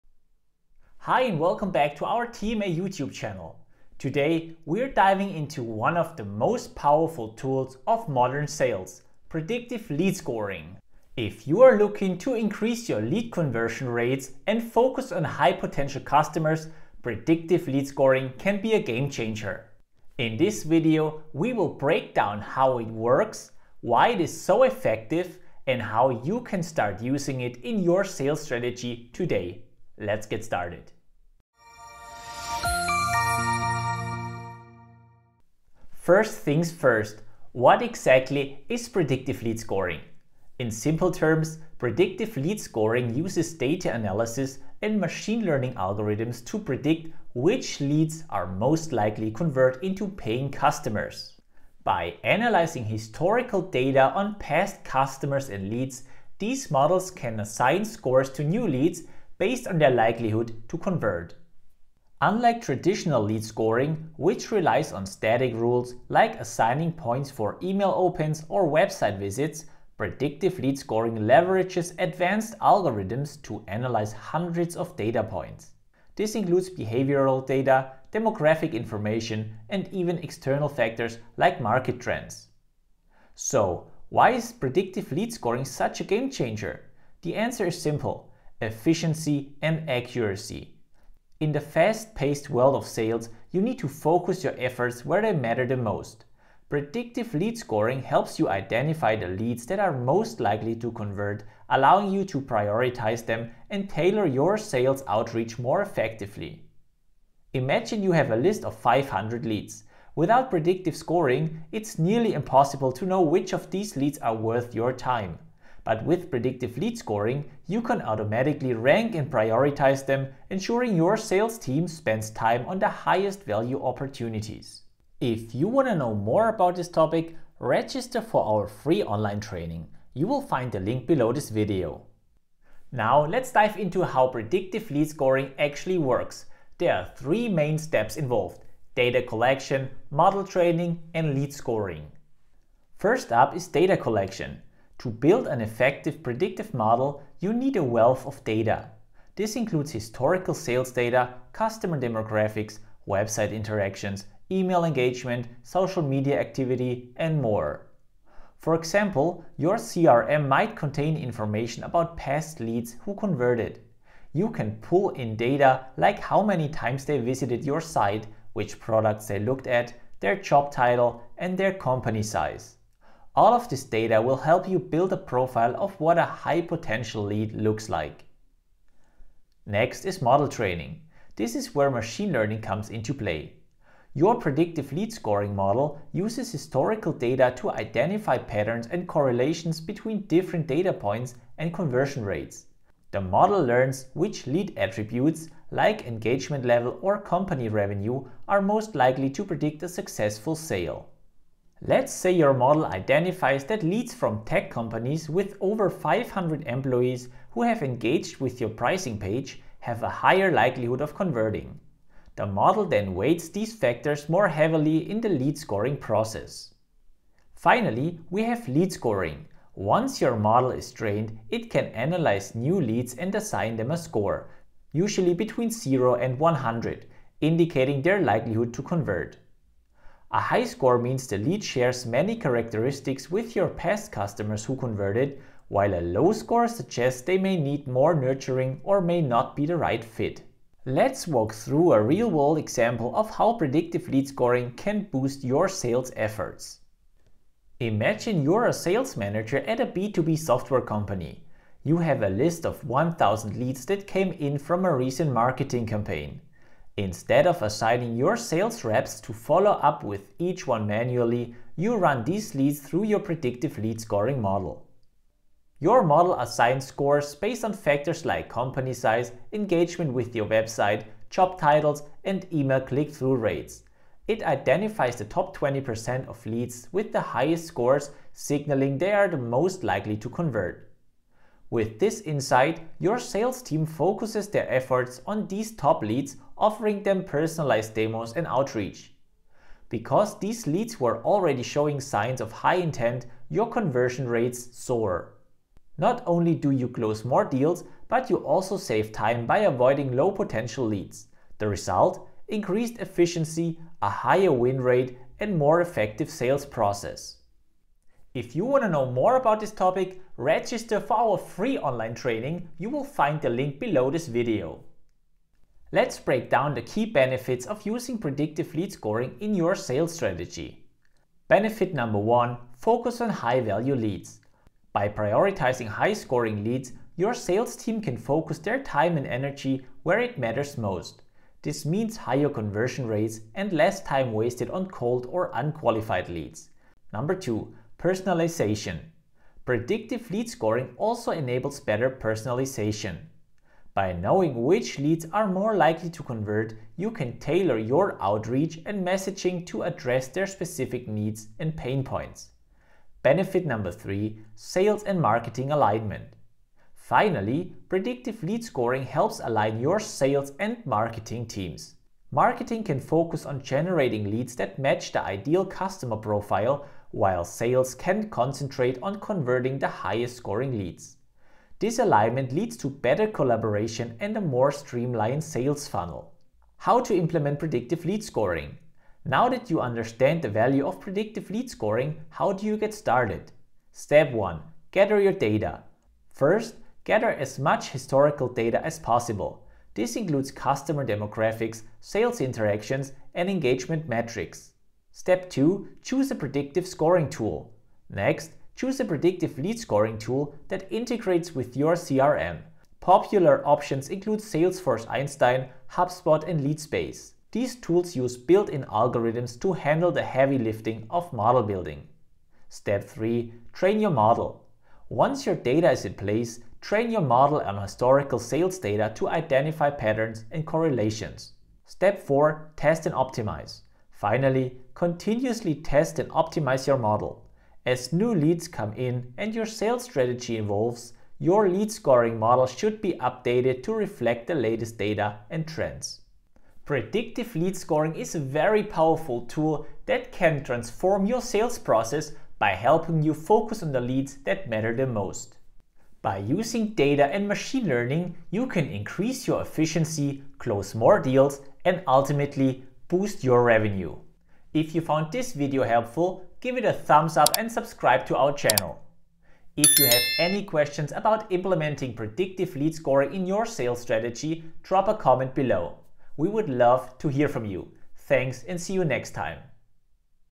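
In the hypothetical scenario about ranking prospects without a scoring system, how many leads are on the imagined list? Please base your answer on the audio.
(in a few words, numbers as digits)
500.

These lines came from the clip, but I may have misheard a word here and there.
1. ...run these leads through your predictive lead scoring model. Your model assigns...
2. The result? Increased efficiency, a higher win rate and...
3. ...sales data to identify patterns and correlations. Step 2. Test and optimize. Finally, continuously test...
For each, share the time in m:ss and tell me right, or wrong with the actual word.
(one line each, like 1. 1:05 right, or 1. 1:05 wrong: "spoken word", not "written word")
1. 4:21 right
2. 5:01 right
3. 6:58 wrong: "4", not "2".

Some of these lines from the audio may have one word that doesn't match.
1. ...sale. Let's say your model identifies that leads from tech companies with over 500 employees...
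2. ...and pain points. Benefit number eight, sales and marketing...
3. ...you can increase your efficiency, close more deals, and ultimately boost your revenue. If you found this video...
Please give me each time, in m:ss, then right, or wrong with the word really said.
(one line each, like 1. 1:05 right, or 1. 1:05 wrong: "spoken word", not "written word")
1. 3:20 right
2. 5:51 wrong: "three", not "eight"
3. 7:28 right.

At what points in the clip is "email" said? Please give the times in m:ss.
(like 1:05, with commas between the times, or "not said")
1:07, 2:34, 4:32.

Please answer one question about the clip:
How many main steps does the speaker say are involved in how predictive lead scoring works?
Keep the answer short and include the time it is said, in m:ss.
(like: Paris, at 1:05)
3, at 2:17.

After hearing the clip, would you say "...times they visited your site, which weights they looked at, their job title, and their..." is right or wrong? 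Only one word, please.
wrong.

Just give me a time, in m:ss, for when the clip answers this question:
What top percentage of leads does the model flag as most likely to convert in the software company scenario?
4:35.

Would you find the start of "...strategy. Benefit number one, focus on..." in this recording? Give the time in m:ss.
5:20.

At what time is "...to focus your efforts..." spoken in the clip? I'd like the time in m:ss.
1:33.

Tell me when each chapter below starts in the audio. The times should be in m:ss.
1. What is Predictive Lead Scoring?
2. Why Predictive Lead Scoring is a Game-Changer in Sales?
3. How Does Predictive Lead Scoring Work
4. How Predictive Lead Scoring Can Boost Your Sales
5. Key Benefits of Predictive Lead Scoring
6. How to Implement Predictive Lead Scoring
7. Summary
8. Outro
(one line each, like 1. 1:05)
1. 0:35
2. 1:23
3. 2:12
4. 4:00
5. 5:16
6. 6:17
7. 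7:17
8. 7:35.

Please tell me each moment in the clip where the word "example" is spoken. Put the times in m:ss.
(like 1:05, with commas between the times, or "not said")
2:38, 4:02.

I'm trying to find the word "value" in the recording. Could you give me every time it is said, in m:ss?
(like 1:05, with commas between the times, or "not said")
2:03, 5:23, 6:20.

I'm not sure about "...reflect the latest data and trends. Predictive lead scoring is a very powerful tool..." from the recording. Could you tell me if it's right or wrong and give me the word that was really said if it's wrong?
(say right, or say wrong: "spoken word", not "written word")
right.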